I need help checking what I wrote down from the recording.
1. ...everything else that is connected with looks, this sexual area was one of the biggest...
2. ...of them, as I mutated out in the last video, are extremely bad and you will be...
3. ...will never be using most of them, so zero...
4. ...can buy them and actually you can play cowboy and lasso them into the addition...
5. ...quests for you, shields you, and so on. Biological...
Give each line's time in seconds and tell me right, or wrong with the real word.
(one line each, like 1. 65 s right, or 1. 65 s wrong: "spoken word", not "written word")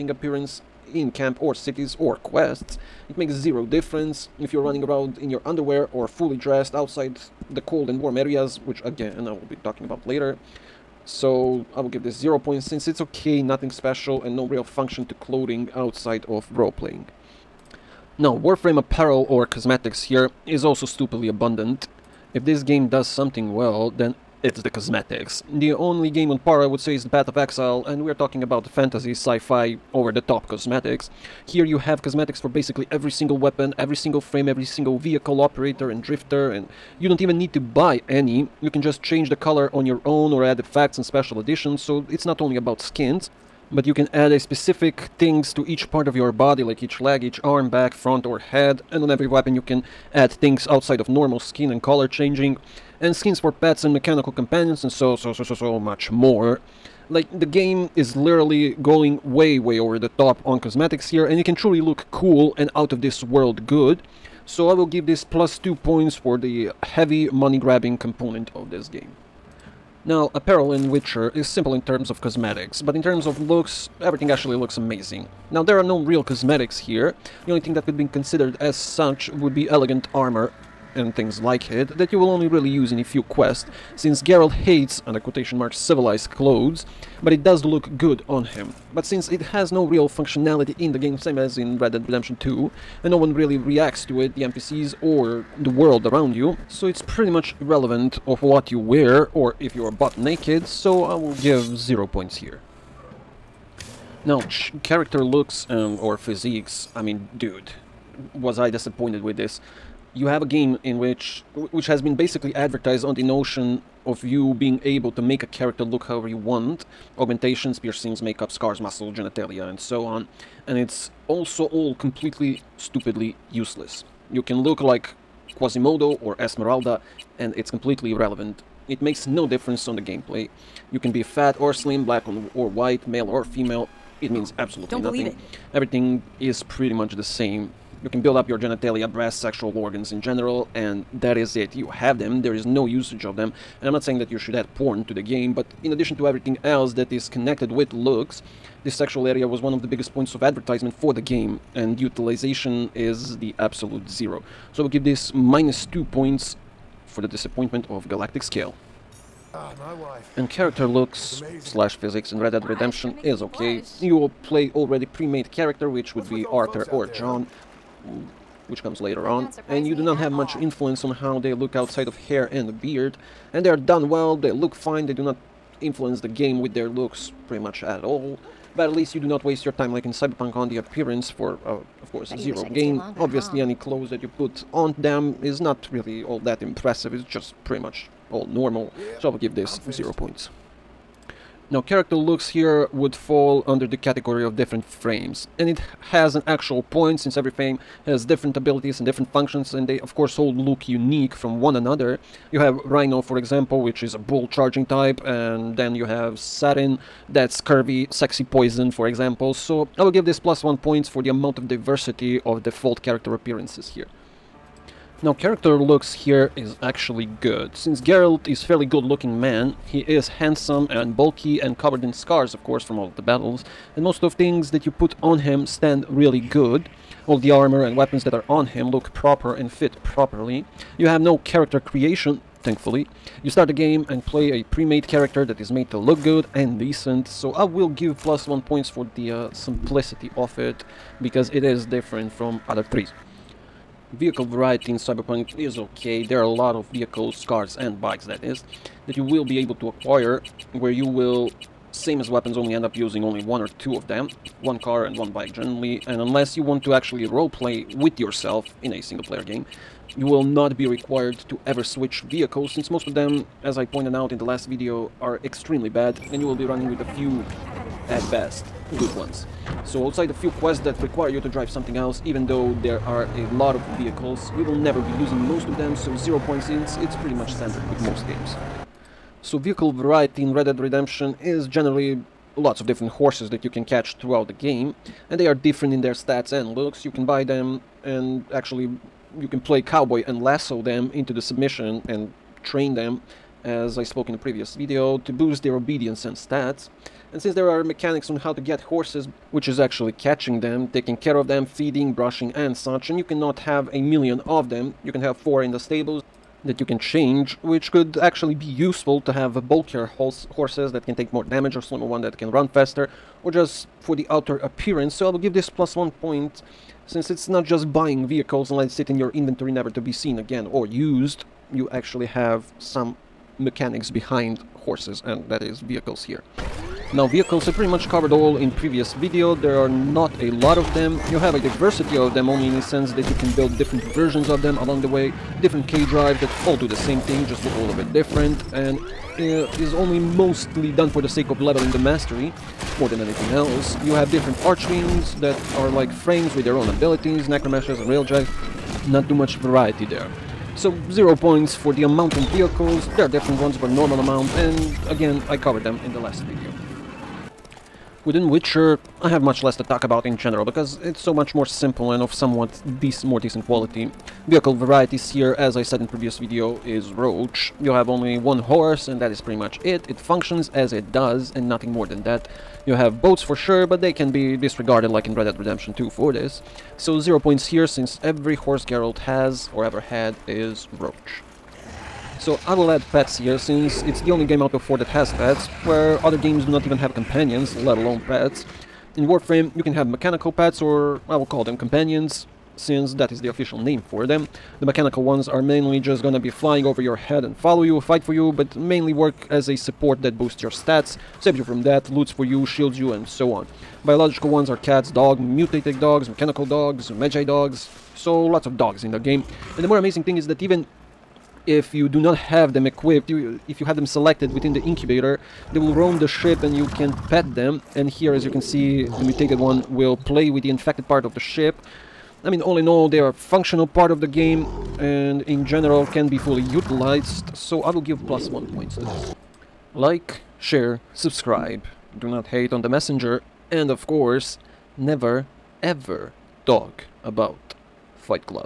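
1. 146 s right
2. 263 s wrong: "pointed", not "mutated"
3. 274 s right
4. 287 s wrong: "submission", not "addition"
5. 402 s wrong: "loots", not "quests".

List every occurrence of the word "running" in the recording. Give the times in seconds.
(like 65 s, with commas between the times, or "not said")
4 s, 266 s.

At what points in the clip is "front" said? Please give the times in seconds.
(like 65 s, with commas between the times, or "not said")
47 s.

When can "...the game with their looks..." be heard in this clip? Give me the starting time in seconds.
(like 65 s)
176 s.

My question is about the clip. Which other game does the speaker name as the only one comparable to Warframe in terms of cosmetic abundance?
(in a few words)
Path of Exile.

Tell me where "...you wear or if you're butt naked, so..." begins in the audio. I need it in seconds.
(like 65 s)
98 s.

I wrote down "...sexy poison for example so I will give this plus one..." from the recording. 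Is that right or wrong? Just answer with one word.
right.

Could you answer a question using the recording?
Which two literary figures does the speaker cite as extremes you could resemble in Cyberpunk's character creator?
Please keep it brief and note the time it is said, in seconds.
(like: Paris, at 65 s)
Quasimodo or Esmeralda, at 125 s.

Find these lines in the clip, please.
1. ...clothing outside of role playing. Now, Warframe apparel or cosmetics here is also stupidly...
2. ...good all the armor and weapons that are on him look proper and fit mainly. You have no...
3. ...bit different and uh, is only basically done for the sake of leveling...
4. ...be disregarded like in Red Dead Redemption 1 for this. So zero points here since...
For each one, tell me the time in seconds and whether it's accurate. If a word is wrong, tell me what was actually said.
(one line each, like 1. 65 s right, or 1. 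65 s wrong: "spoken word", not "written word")
1. 15 s right
2. 226 s wrong: "properly", not "mainly"
3. 337 s wrong: "mostly", not "basically"
4. 374 s wrong: "2", not "1".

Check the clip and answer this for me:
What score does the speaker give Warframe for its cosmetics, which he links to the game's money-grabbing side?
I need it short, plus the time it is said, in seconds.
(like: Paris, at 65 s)
+2, at 65 s.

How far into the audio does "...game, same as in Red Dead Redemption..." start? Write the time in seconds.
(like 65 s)
90 s.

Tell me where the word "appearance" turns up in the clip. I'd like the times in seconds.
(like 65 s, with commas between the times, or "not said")
0 s, 180 s, 213 s, 314 s.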